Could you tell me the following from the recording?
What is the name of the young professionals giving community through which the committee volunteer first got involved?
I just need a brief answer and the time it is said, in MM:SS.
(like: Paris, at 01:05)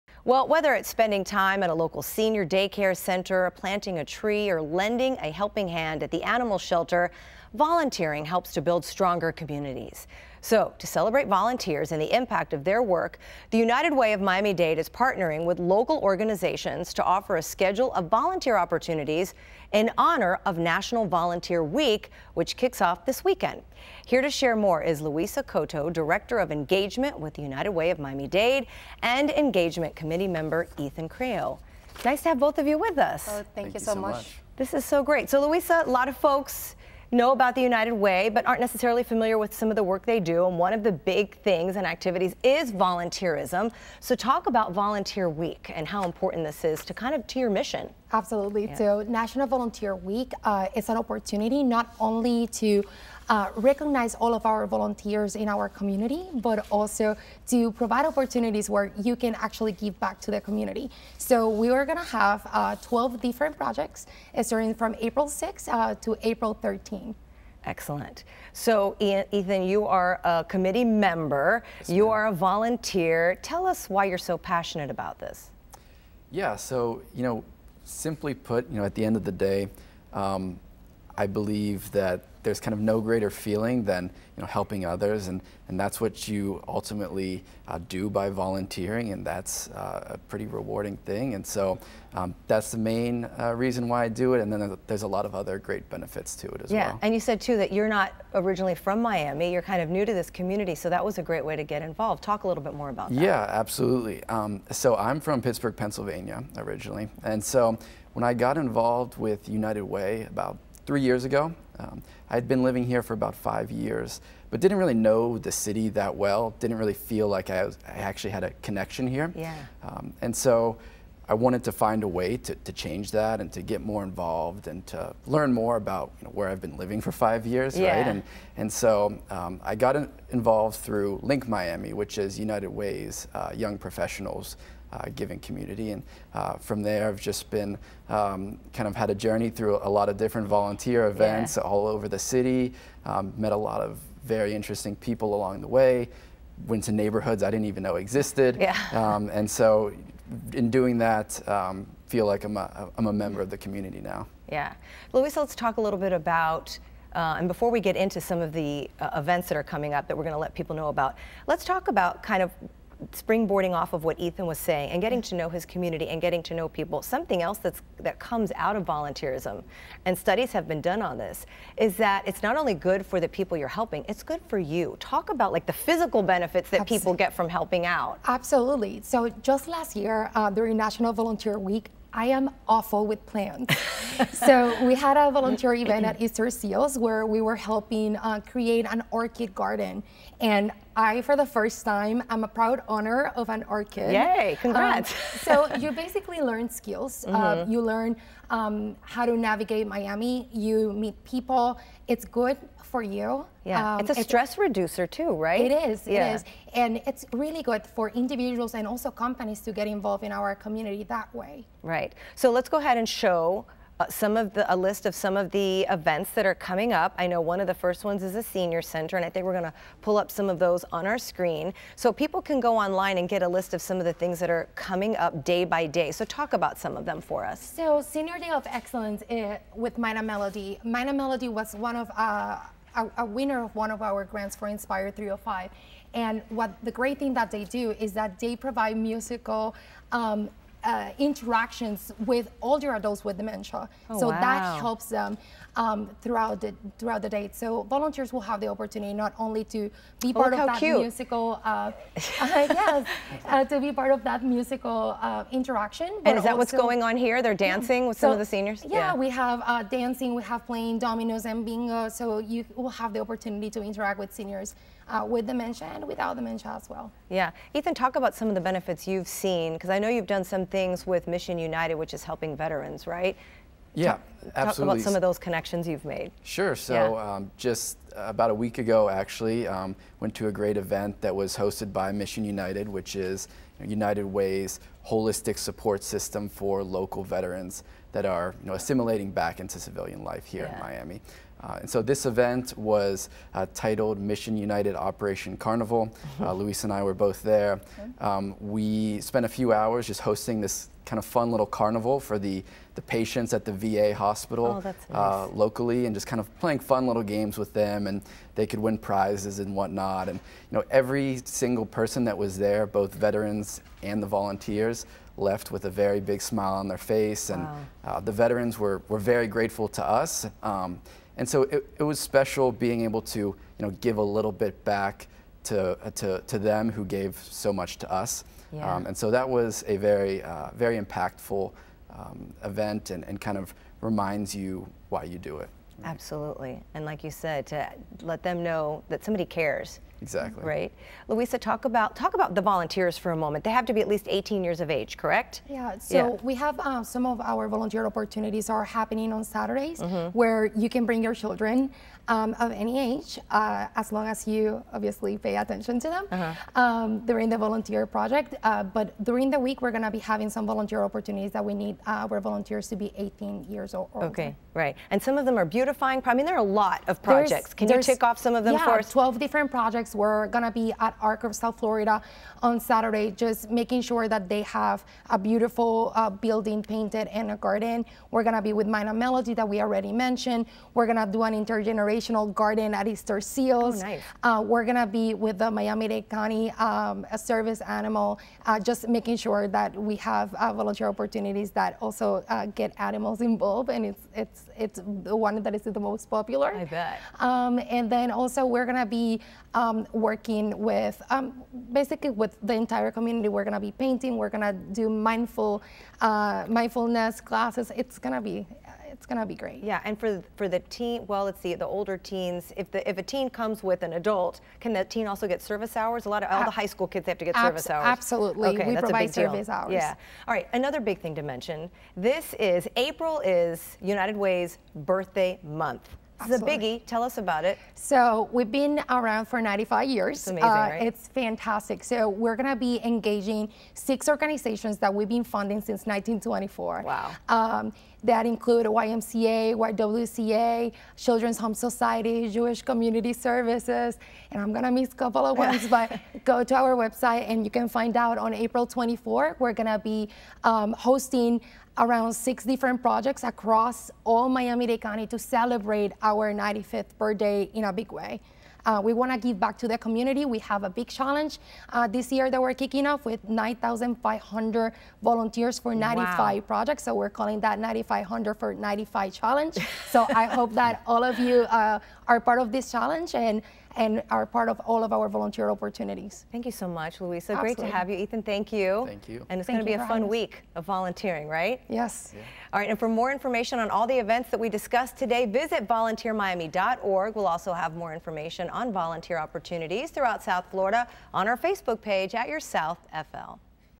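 Link Miami, at 02:11.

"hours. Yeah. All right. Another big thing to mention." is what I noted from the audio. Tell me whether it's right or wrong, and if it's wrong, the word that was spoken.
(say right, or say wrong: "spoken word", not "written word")
right.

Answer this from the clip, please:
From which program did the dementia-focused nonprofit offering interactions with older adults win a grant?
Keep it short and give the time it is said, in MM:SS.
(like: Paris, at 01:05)
Inspire 305, at 03:54.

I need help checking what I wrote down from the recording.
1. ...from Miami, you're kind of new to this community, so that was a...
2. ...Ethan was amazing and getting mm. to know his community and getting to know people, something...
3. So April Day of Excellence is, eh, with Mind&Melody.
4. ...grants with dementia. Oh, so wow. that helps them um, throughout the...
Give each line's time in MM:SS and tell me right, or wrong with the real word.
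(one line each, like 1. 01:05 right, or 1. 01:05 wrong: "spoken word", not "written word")
1. 01:38 right
2. 02:44 wrong: "saying", not "amazing"
3. 03:47 wrong: "Senior", not "April"
4. 04:02 wrong: "adults", not "grants".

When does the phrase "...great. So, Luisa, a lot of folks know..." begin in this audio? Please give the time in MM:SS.
00:35.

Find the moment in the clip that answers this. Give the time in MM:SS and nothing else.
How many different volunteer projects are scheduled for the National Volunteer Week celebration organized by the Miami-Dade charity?
01:02.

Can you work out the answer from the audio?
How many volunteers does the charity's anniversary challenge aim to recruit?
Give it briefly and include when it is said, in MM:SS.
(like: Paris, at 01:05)
9,500, at 07:43.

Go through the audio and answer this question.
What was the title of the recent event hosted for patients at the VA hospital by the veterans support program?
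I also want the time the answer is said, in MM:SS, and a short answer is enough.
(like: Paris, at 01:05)
Operation Carnival, at 04:54.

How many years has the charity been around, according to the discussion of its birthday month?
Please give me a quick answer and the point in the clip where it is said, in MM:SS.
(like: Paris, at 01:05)
95, at 07:09.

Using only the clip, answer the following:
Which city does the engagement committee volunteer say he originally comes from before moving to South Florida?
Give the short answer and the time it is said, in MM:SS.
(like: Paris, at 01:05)
Pittsburgh, at 01:45.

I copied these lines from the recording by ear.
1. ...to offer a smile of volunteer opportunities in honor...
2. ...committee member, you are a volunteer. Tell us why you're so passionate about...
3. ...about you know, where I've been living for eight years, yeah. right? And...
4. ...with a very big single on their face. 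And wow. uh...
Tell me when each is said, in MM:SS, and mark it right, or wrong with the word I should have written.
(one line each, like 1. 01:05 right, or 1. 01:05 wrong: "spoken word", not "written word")
1. 00:16 wrong: "schedule", not "smile"
2. 01:10 right
3. 02:05 wrong: "five", not "eight"
4. 05:15 wrong: "smile", not "single".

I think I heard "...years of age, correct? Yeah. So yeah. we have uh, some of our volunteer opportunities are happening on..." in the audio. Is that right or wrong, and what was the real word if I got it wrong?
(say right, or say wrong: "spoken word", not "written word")
right.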